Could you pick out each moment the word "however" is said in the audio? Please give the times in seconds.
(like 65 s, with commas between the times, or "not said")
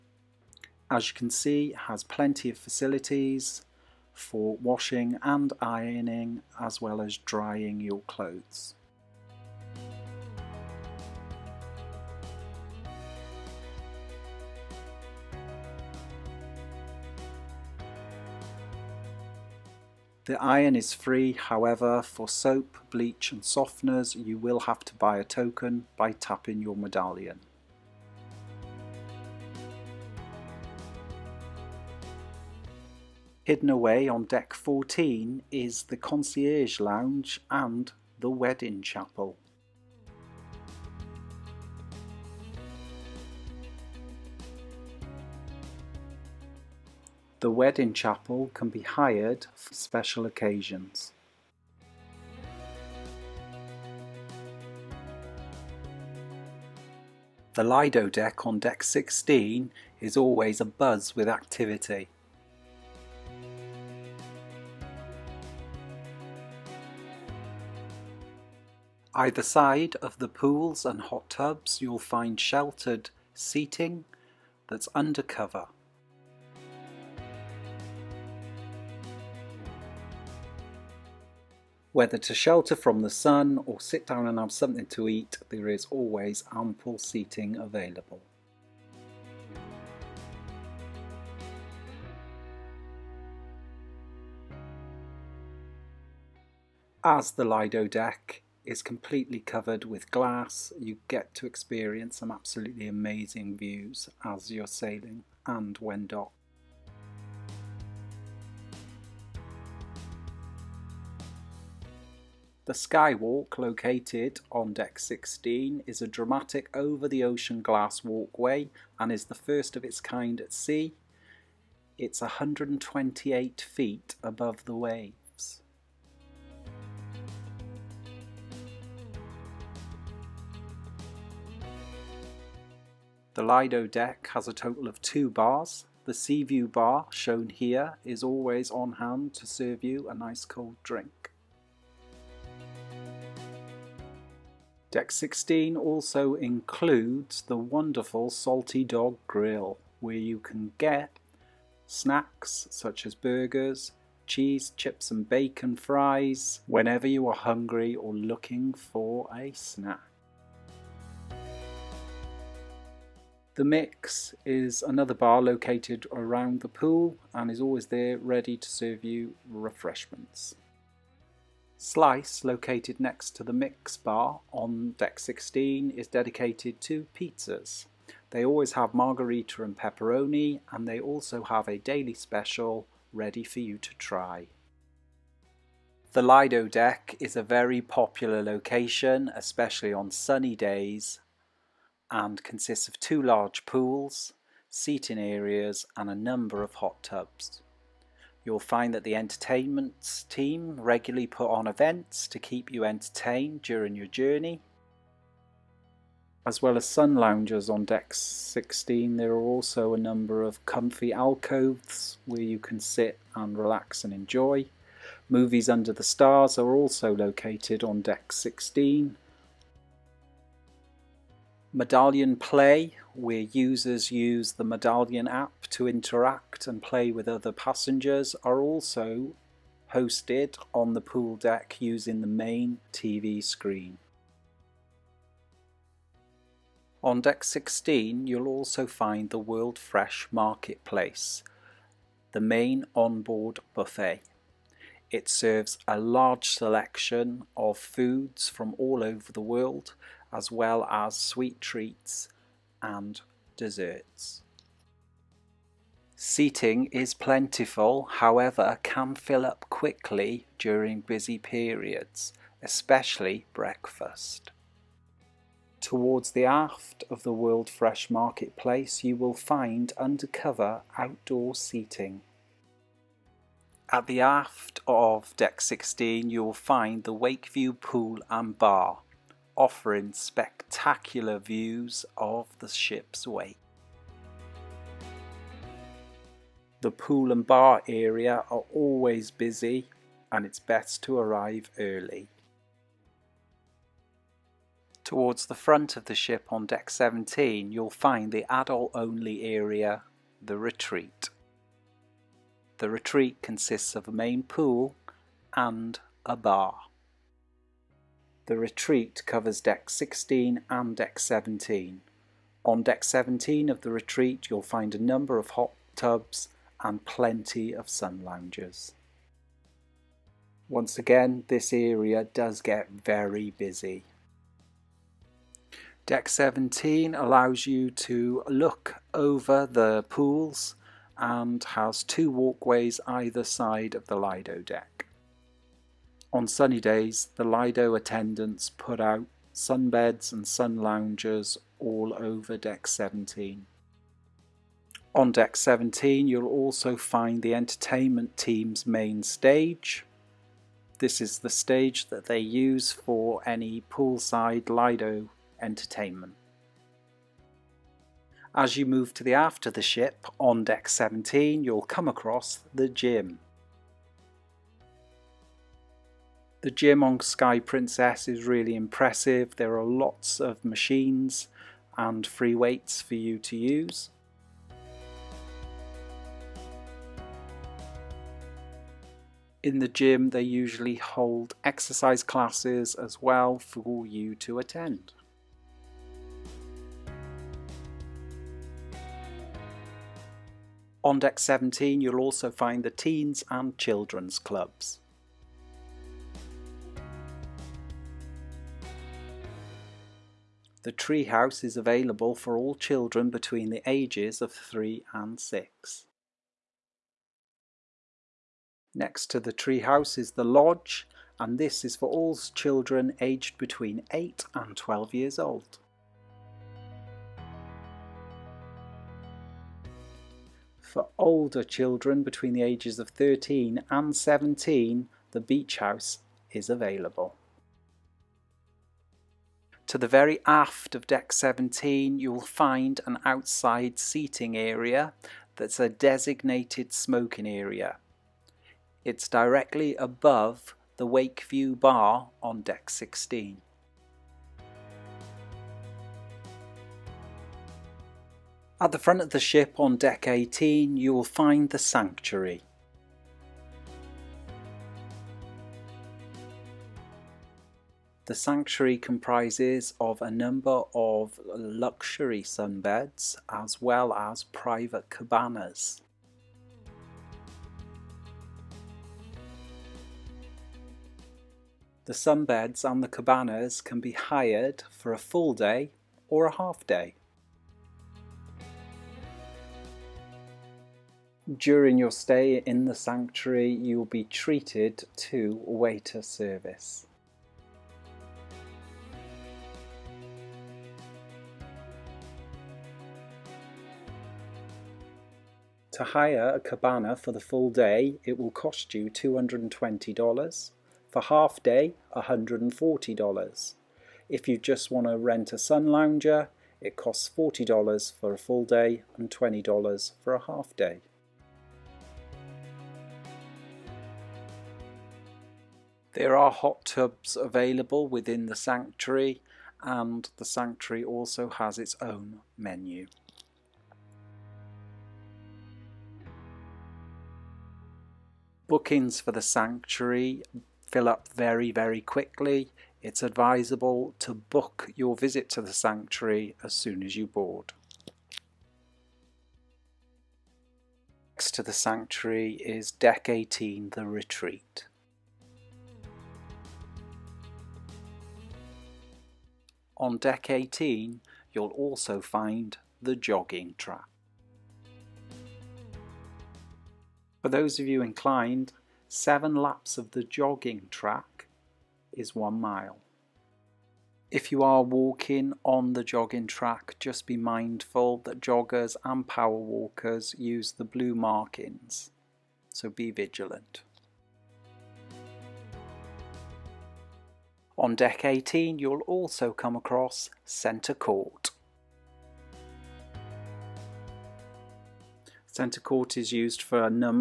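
21 s, 258 s.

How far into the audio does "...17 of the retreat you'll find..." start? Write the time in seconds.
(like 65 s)
313 s.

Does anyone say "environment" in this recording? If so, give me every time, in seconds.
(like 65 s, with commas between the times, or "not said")
not said.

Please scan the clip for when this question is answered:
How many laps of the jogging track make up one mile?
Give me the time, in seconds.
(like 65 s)
559 s.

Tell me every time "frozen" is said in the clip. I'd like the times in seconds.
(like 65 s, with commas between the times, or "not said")
not said.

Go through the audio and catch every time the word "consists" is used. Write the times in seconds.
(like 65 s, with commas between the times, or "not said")
192 s, 303 s.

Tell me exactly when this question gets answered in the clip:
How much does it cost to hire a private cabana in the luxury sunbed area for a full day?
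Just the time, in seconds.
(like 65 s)
499 s.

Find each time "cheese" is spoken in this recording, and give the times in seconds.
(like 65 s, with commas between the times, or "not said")
154 s.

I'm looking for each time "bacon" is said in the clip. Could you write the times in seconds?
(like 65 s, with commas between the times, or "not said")
155 s.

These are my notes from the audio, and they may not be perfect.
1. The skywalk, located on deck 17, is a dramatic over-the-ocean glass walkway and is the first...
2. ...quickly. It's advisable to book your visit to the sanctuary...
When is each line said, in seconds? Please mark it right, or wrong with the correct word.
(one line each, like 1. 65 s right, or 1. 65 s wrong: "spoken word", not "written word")
1. 112 s wrong: "16", not "17"
2. 532 s right.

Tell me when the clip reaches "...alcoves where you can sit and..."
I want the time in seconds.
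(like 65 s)
211 s.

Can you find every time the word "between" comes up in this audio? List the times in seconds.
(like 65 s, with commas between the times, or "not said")
403 s, 413 s, 422 s.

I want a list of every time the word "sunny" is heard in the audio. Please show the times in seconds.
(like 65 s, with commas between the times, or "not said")
190 s, 336 s.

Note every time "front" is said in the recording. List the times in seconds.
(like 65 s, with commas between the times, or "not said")
295 s, 448 s.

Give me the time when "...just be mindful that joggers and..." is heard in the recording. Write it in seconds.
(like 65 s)
567 s.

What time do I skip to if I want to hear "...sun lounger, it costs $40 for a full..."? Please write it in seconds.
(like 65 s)
505 s.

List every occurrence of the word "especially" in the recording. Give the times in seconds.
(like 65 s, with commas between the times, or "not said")
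189 s, 262 s.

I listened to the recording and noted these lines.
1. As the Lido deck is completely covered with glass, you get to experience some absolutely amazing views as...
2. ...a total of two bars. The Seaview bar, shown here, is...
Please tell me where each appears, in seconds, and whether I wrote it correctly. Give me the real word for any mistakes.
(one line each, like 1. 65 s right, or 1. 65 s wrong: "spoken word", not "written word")
1. 97 s right
2. 134 s right.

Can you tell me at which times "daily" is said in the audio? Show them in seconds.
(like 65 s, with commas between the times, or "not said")
181 s.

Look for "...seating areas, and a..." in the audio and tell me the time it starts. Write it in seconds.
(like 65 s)
194 s.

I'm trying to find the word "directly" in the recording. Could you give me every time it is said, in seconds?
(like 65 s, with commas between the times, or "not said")
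439 s.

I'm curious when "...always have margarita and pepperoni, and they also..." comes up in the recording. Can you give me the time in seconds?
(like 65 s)
178 s.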